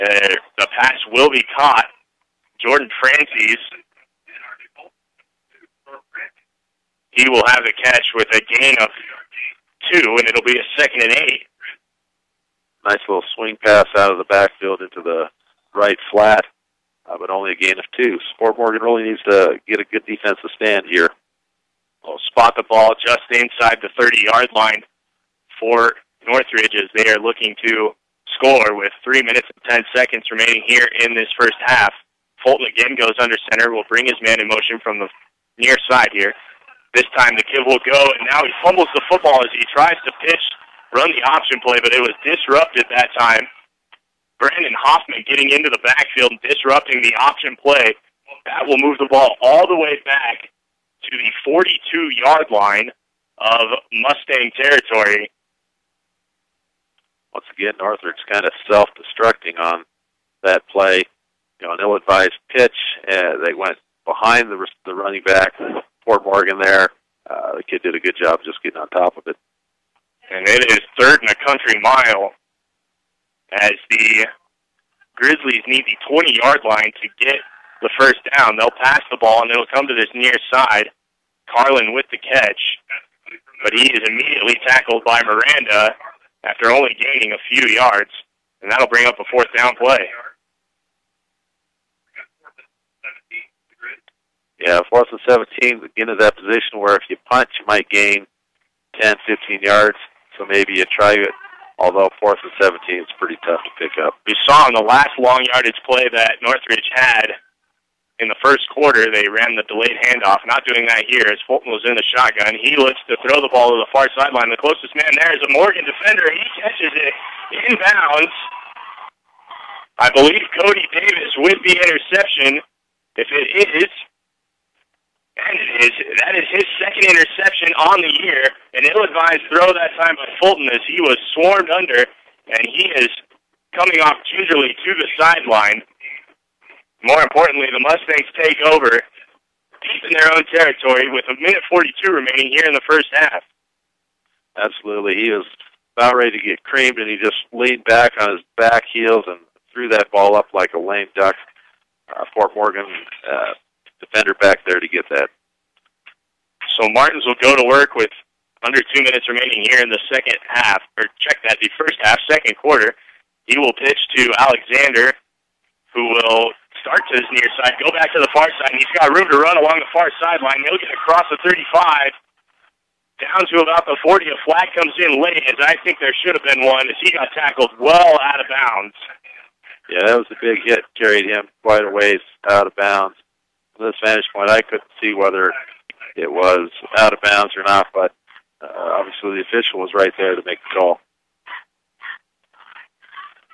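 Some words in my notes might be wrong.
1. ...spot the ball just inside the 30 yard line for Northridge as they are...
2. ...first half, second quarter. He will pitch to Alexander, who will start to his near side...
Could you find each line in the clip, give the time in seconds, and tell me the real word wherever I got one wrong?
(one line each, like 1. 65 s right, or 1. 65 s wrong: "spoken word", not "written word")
1. 22 s right
2. 161 s right.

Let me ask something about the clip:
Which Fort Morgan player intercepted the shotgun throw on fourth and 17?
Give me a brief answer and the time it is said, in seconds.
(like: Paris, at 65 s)
Cody Davis, at 120 s.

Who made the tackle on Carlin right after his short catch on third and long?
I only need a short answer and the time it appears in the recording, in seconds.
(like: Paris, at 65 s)
Miranda, at 85 s.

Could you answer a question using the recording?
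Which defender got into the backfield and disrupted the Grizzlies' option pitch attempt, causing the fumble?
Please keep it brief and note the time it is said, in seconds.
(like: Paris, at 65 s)
Brandon Hoffman, at 44 s.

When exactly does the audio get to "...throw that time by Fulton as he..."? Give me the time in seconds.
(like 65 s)
129 s.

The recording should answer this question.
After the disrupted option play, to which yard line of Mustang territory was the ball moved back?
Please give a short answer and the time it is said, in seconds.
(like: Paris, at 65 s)
42, at 51 s.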